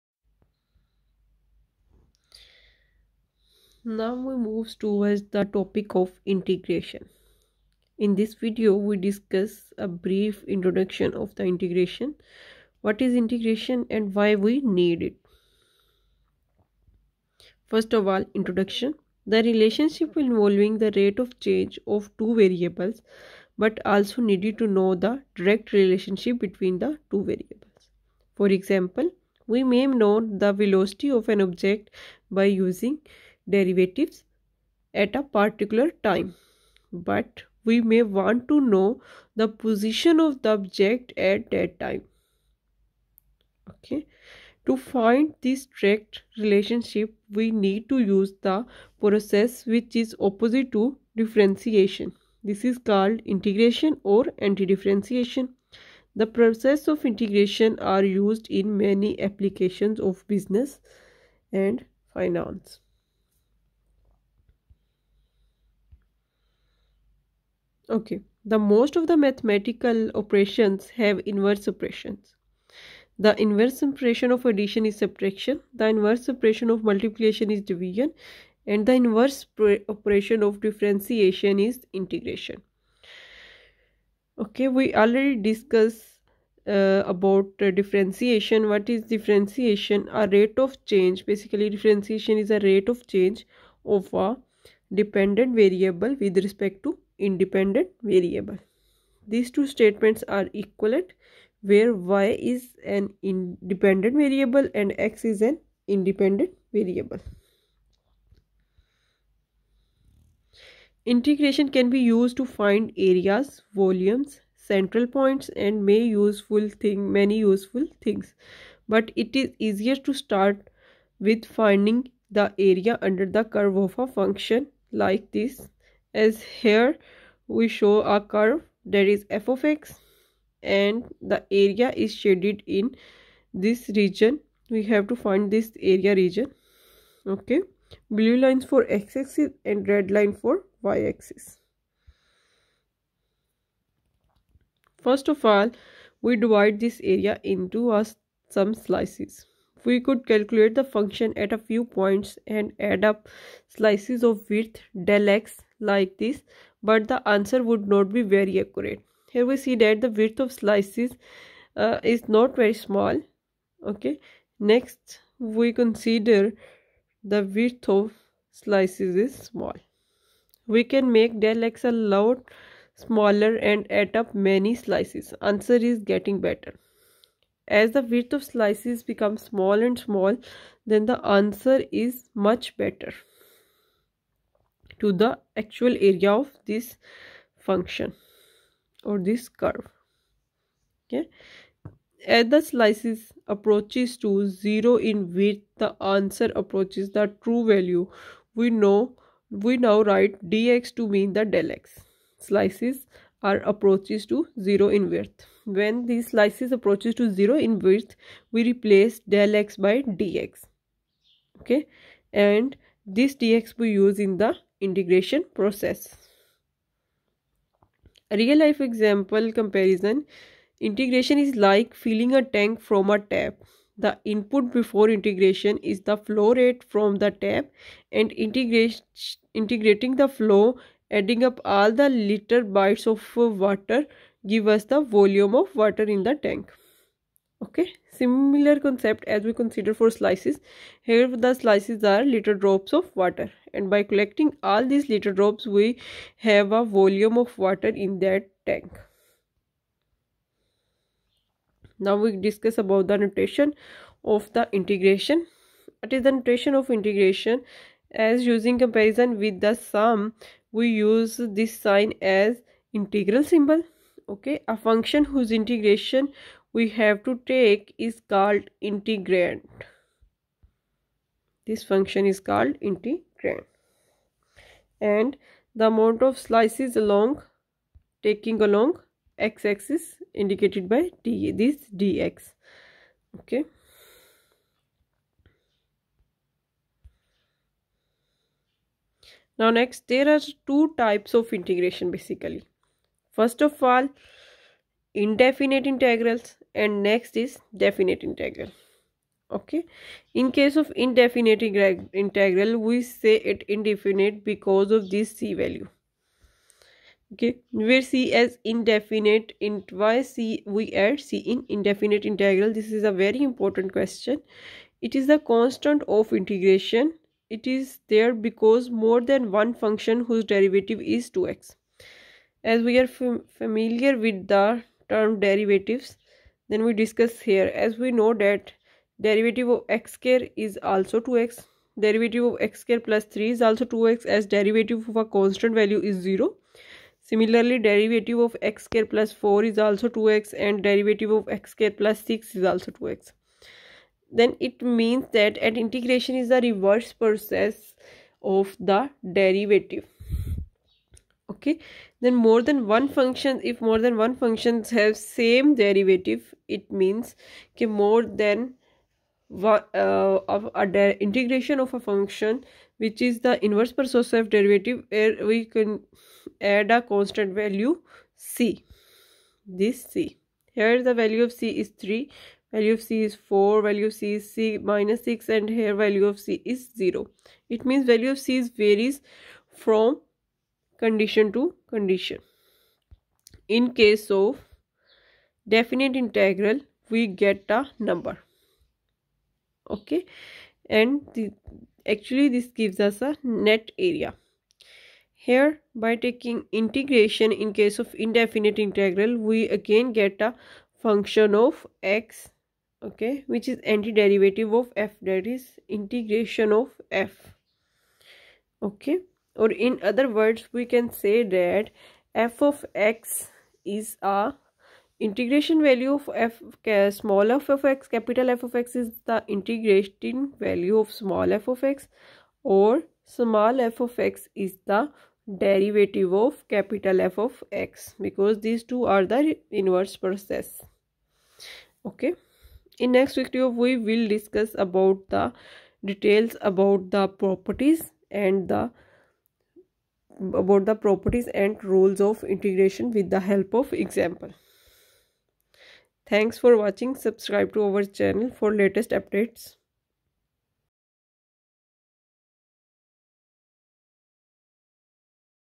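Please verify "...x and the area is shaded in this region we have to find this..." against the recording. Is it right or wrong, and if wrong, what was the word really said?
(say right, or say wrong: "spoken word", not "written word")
right.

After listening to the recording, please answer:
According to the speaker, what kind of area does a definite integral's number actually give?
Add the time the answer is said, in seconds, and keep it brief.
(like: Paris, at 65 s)
net area, at 393 s.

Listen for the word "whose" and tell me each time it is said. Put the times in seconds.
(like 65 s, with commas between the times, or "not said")
265 s, 320 s.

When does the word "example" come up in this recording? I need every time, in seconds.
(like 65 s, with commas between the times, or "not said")
28 s, 218 s, 443 s.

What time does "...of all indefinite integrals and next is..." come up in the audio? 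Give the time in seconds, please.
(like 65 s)
293 s.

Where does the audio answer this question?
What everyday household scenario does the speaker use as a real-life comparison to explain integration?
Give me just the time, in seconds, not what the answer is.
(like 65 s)
221 s.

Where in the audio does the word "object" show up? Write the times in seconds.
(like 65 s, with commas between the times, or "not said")
31 s, 40 s.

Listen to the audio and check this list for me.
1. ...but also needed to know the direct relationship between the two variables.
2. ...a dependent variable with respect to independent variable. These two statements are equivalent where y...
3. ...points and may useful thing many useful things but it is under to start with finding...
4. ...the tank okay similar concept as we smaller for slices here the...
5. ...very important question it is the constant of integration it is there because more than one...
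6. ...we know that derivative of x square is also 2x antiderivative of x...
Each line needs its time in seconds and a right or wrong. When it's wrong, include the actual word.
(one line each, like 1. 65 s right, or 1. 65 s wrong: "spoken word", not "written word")
1. 23 s right
2. 94 s right
3. 115 s wrong: "easier", not "under"
4. 236 s wrong: "consider", not "smaller"
5. 313 s right
6. 328 s wrong: "derivative", not "antiderivative".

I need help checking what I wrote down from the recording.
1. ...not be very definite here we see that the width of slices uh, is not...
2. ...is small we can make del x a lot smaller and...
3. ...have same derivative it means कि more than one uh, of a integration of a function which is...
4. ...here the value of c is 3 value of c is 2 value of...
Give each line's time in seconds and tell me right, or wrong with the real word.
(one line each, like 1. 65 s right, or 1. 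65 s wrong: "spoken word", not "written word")
1. 157 s wrong: "accurate", not "definite"
2. 169 s right
3. 354 s right
4. 370 s wrong: "4", not "2".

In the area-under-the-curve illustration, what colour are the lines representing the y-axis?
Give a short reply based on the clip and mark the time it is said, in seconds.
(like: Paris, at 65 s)
red, at 139 s.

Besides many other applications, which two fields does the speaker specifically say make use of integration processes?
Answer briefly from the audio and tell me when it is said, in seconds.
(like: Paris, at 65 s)
business and finance, at 60 s.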